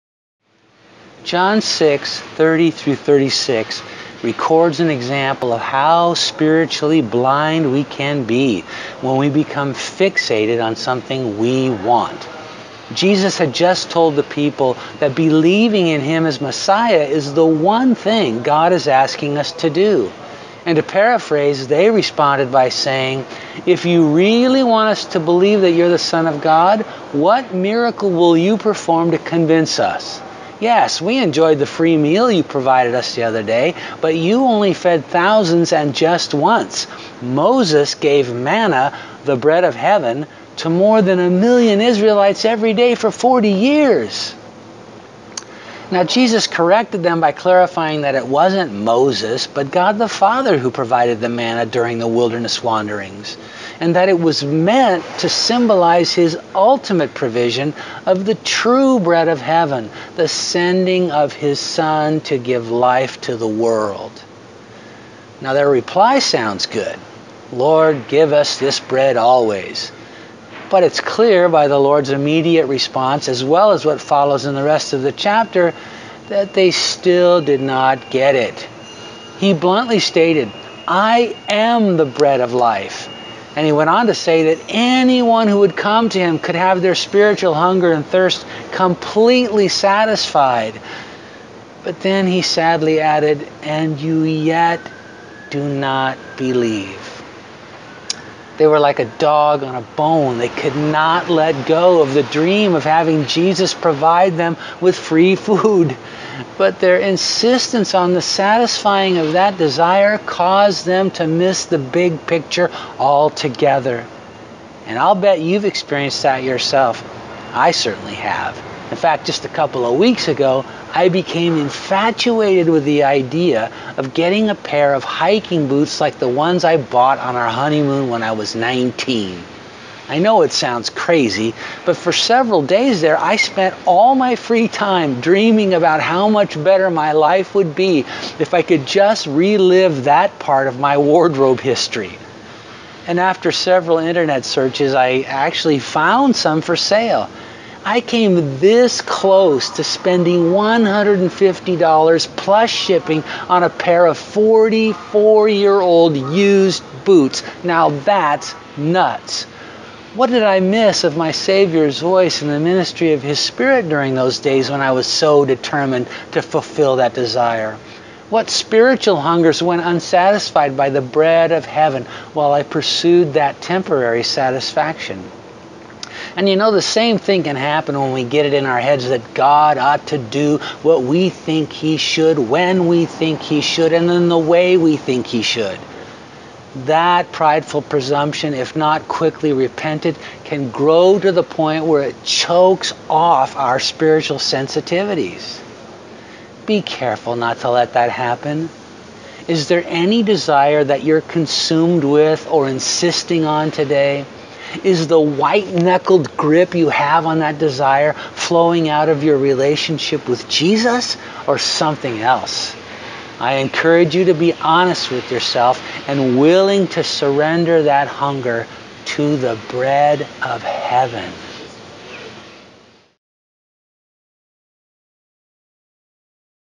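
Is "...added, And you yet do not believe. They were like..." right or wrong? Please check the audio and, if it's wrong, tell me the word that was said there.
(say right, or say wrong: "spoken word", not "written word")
right.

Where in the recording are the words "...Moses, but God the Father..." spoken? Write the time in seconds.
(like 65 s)
48 s.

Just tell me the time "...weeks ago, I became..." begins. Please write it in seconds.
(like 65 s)
119 s.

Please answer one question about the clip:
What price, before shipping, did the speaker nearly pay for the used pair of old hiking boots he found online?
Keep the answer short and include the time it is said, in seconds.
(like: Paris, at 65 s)
$150, at 150 s.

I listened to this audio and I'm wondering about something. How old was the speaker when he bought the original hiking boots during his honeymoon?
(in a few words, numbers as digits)
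19.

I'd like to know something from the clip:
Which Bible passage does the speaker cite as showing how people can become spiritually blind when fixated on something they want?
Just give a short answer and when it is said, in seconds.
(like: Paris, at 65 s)
John 6:30-36, at 1 s.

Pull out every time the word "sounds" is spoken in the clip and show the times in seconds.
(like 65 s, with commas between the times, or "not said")
66 s, 130 s.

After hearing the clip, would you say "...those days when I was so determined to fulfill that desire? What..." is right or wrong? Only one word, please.
right.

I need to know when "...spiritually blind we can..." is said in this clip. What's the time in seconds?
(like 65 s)
6 s.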